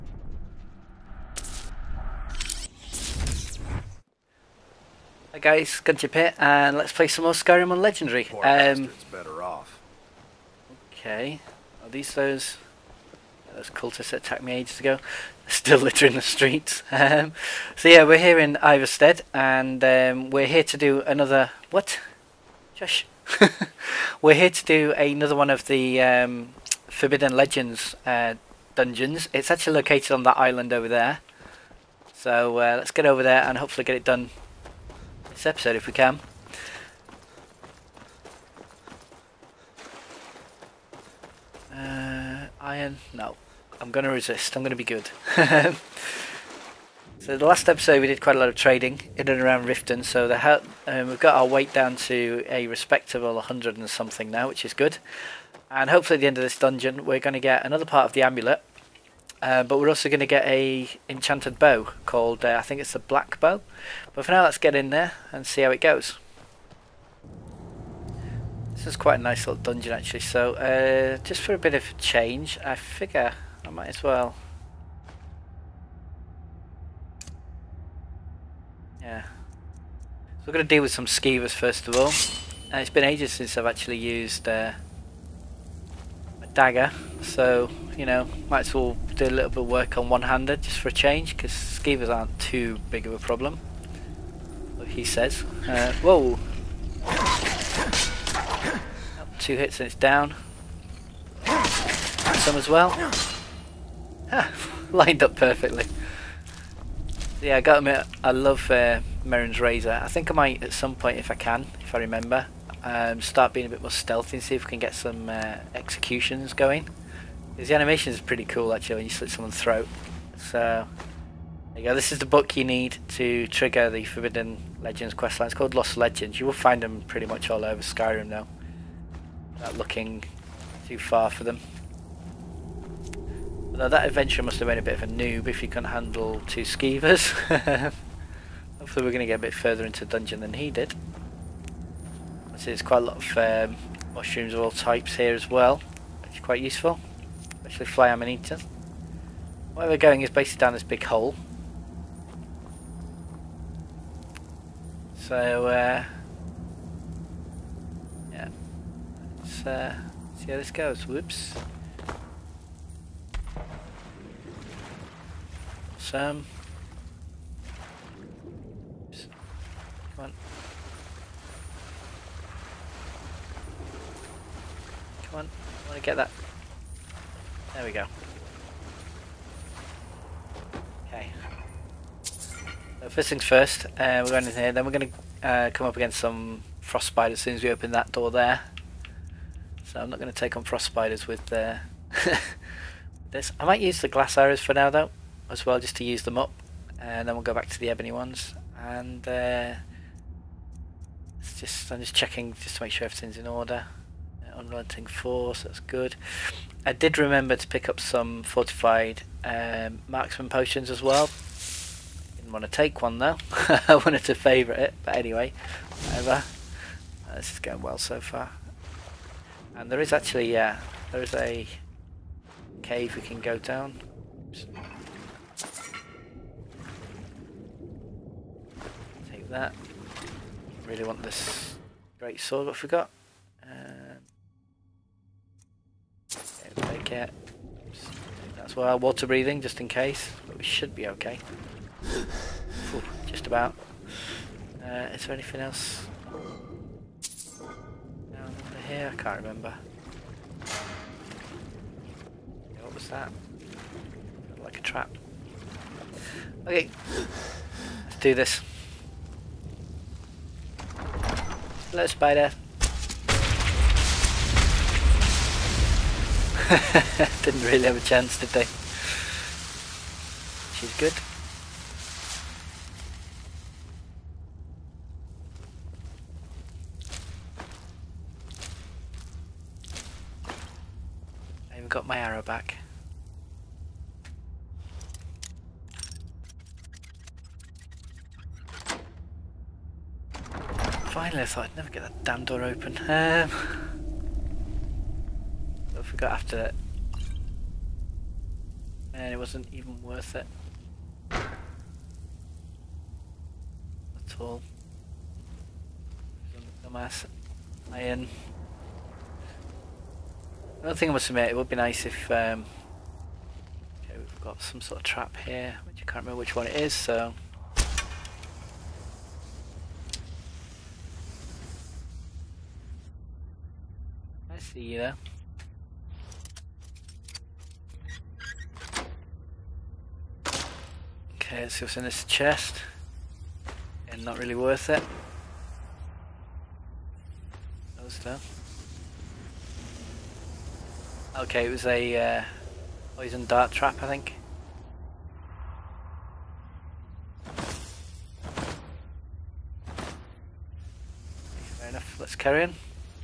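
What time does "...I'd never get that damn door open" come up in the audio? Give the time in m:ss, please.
4:51.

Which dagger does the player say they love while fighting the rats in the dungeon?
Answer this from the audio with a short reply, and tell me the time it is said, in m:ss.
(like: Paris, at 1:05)
Mehrunes' Razor, at 1:49.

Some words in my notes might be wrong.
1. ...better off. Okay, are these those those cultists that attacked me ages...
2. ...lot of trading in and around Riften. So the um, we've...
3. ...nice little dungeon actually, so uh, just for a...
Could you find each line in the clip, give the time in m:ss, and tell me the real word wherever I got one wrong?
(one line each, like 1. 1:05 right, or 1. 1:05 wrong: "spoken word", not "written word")
1. 0:09 right
2. 0:48 right
3. 1:09 right.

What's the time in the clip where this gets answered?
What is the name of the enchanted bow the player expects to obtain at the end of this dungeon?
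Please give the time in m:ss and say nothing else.
1:02.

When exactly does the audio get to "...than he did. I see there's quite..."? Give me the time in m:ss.
2:20.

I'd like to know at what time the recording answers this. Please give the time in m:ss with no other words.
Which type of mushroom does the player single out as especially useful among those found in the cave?
2:27.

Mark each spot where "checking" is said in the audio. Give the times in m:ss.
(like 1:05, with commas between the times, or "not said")
3:22.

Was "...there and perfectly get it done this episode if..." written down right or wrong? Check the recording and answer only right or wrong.
wrong.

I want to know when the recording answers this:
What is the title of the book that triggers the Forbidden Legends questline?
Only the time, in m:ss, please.
2:05.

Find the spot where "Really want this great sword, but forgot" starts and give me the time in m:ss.
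3:50.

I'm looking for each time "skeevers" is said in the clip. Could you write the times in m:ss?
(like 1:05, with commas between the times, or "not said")
1:21, 1:31, 2:16.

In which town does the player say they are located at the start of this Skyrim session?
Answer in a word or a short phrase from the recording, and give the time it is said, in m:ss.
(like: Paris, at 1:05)
Ivarstead, at 0:18.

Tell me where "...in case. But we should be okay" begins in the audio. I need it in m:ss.
3:59.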